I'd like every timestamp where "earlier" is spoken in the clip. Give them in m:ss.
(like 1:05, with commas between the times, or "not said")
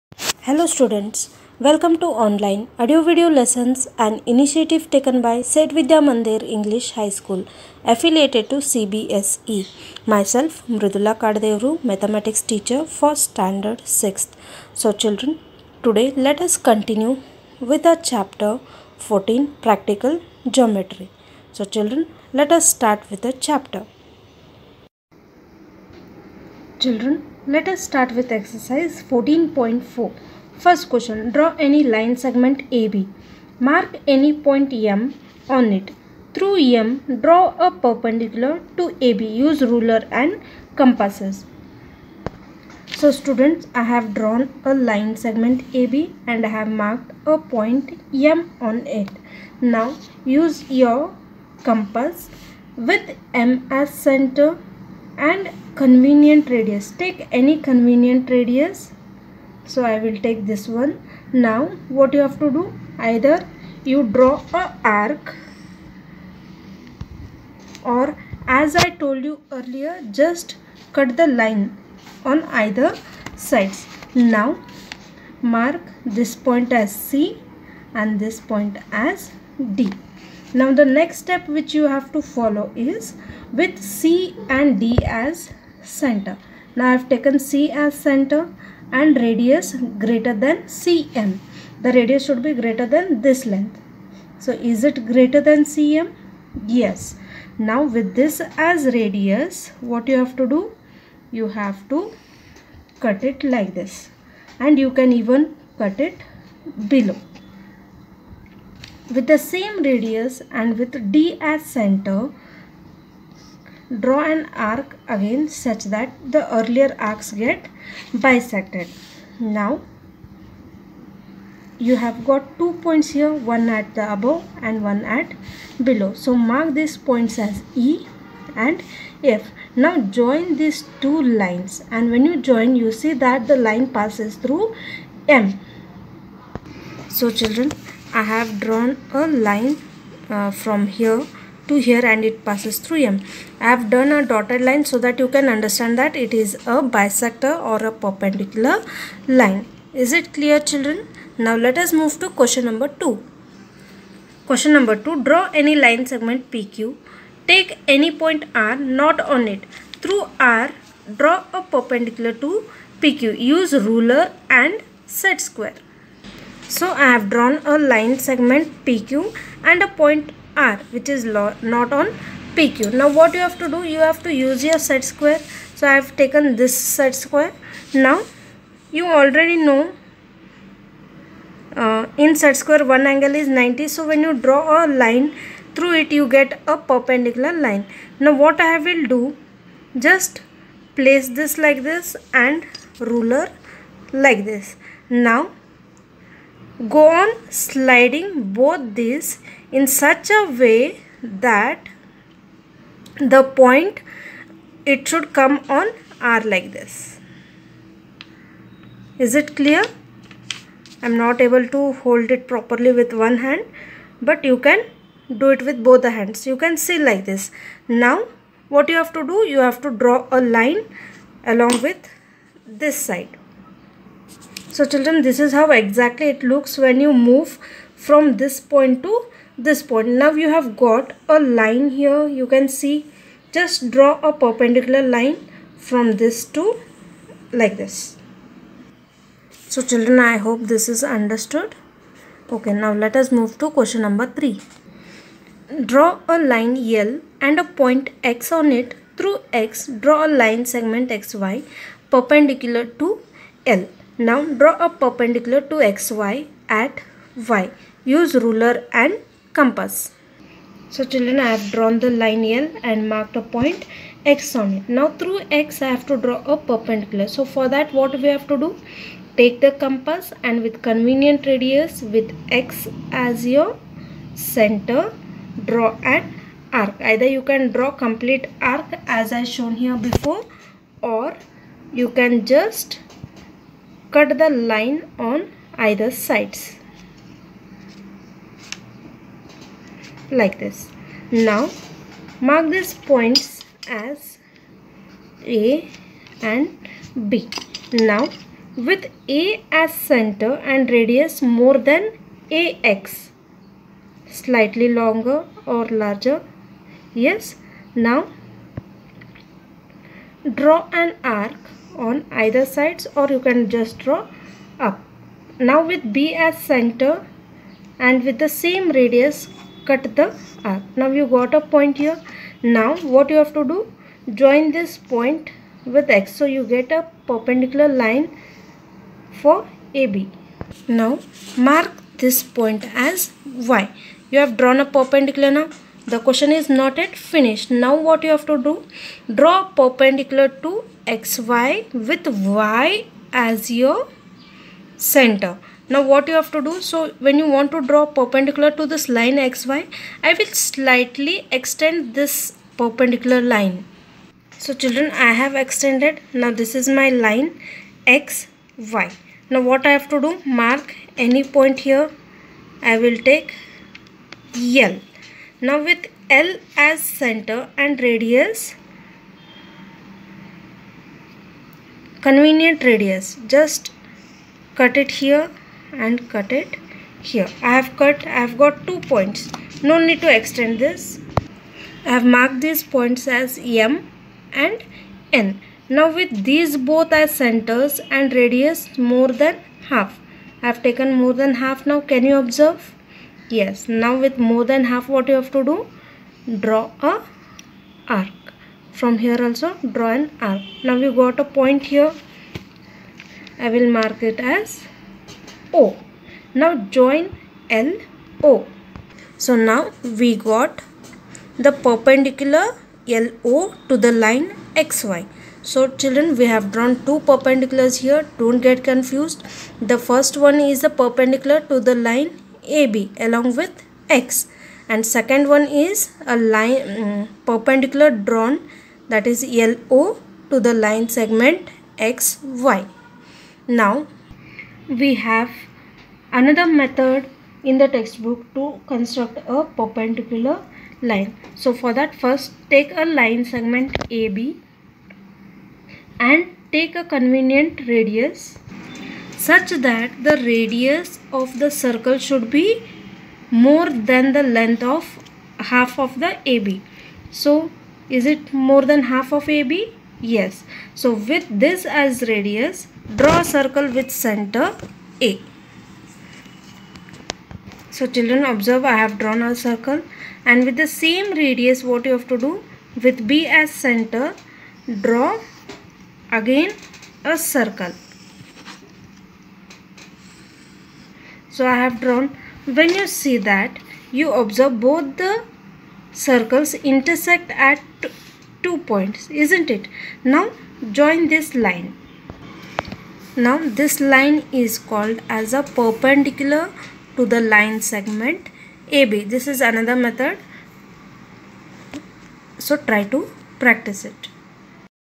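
1:09, 1:56.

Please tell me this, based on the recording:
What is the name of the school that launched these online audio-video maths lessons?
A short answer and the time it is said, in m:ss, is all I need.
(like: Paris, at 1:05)
Said Vidya Mandir English High School, at 0:05.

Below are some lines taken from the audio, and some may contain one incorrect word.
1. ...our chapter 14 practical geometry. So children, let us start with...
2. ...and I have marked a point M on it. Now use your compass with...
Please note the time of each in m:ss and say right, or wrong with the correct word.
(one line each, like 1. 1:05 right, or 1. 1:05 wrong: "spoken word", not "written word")
1. 0:17 right
2. 0:46 right.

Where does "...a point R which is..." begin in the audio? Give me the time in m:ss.
2:49.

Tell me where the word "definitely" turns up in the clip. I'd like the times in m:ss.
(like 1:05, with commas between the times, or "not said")
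not said.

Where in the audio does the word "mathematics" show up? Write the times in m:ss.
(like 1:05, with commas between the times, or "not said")
0:11.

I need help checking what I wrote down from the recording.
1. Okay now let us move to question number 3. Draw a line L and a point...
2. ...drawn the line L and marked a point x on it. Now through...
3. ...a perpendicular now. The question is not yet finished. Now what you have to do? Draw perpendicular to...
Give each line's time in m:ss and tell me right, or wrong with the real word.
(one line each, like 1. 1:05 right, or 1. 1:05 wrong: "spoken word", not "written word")
1. 4:02 right
2. 4:21 right
3. 5:34 right.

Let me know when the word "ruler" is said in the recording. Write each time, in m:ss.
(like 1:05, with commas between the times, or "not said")
0:39, 2:43, 3:12, 4:18.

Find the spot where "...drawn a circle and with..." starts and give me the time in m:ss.
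7:49.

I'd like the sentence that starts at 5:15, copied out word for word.
Now with B as center and with the same radius cut the arc.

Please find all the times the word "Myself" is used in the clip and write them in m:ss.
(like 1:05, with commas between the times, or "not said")
0:10.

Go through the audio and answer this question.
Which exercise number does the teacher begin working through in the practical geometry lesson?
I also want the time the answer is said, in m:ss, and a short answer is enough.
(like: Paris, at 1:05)
14.4, at 0:28.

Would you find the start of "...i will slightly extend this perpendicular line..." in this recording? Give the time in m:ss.
5:50.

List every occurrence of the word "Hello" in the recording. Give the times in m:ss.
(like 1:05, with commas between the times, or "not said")
0:00.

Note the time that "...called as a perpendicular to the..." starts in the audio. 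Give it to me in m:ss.
8:14.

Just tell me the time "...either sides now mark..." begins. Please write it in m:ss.
1:12.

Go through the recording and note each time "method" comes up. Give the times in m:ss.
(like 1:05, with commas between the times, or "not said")
7:16, 8:19.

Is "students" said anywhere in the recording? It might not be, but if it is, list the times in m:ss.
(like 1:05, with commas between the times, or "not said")
0:00, 0:43.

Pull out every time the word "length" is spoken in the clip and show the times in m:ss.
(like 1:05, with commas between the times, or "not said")
1:33, 7:34.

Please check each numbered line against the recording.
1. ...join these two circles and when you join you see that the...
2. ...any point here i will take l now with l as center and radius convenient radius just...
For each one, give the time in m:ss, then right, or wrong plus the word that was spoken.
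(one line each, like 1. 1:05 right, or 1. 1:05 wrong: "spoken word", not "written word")
1. 2:09 wrong: "lines", not "circles"
2. 6:01 right.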